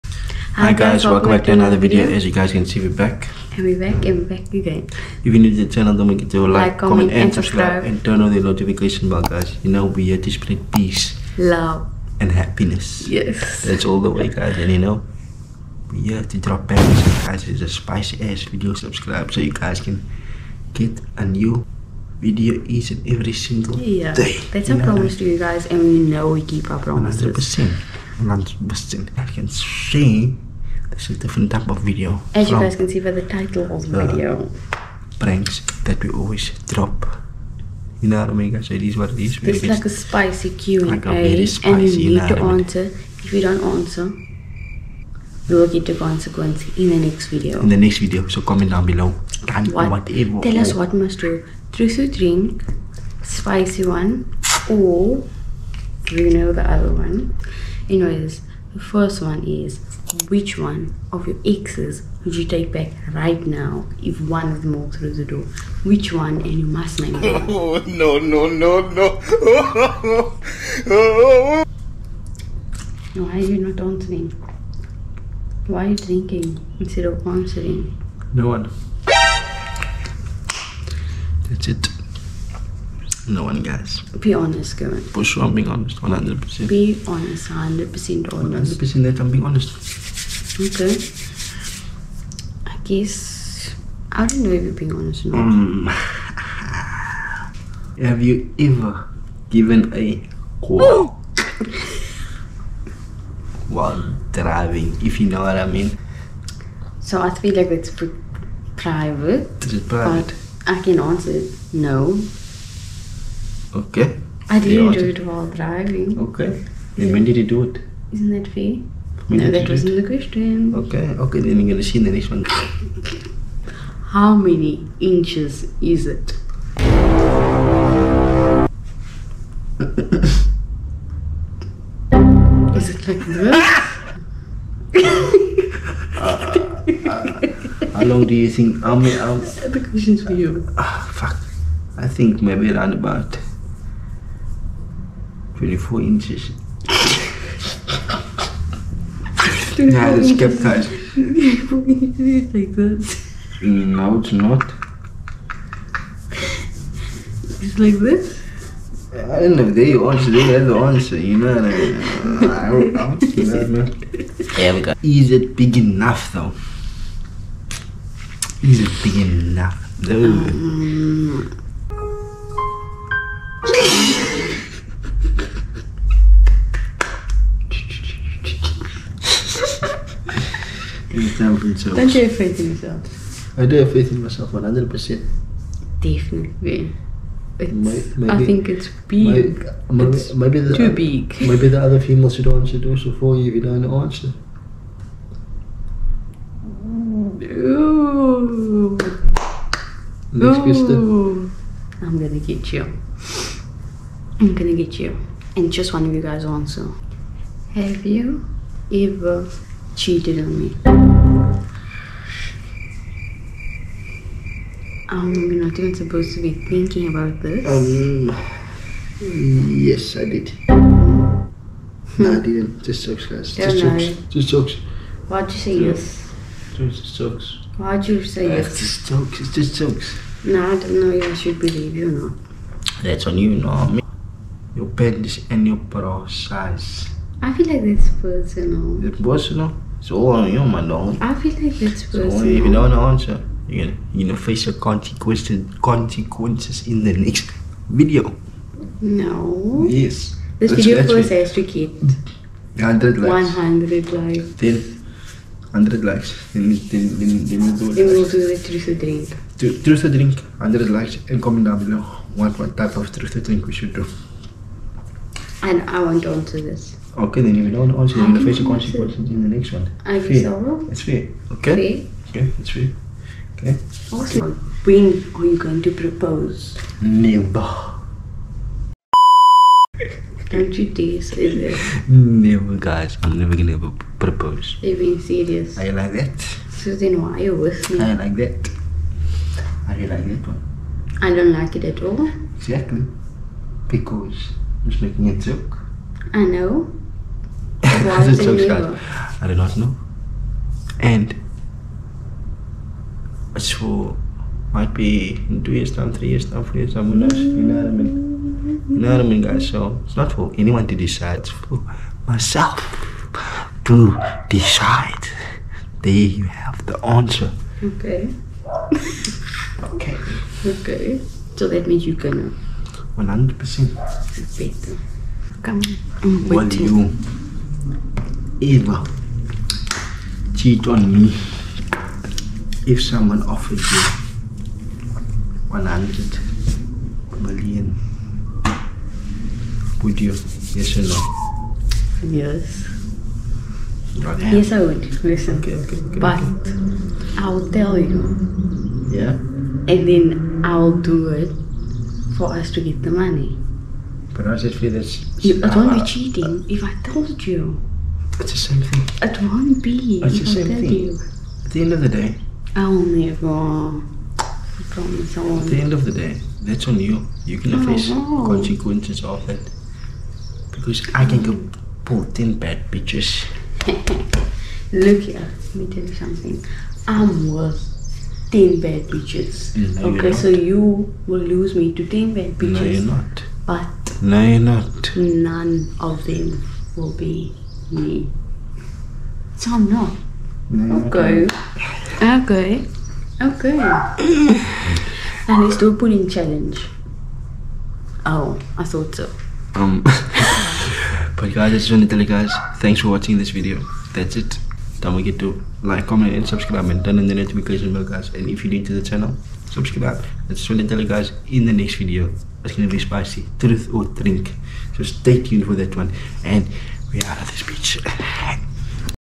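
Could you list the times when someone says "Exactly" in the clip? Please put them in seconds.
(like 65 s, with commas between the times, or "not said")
292 s.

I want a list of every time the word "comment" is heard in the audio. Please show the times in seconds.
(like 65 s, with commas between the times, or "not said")
6 s, 48 s, 261 s, 406 s.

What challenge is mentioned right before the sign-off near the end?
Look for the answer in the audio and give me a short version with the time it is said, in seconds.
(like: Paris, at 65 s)
pudding challenge, at 395 s.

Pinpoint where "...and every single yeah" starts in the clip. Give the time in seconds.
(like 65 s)
22 s.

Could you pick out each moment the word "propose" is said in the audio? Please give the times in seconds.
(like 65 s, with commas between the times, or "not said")
275 s, 284 s.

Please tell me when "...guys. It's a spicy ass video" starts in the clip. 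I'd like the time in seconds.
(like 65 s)
17 s.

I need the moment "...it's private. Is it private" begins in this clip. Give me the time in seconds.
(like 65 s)
107 s.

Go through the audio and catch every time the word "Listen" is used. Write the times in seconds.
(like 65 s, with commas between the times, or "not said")
345 s.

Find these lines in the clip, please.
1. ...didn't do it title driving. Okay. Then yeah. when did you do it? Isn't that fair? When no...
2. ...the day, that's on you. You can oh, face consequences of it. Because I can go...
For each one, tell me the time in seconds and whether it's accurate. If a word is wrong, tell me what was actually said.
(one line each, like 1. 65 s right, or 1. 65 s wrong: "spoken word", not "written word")
1. 114 s wrong: "while", not "title"
2. 366 s right.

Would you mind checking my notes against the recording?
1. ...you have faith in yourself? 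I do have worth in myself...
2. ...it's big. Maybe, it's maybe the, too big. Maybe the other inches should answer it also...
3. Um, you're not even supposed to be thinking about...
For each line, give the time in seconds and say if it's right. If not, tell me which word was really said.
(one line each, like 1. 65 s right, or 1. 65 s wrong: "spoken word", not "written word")
1. 182 s wrong: "faith", not "worth"
2. 188 s wrong: "females", not "inches"
3. 215 s right.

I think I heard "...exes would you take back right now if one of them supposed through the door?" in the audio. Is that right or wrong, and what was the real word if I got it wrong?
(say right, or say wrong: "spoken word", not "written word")
wrong: "walked", not "supposed".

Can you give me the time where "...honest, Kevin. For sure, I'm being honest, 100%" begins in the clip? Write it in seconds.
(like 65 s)
84 s.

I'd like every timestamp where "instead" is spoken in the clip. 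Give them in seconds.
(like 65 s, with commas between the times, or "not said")
76 s.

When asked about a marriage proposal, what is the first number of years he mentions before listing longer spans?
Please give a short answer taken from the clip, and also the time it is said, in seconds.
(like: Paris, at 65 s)
2, at 305 s.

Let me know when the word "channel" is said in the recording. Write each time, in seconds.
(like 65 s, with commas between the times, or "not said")
5 s, 409 s.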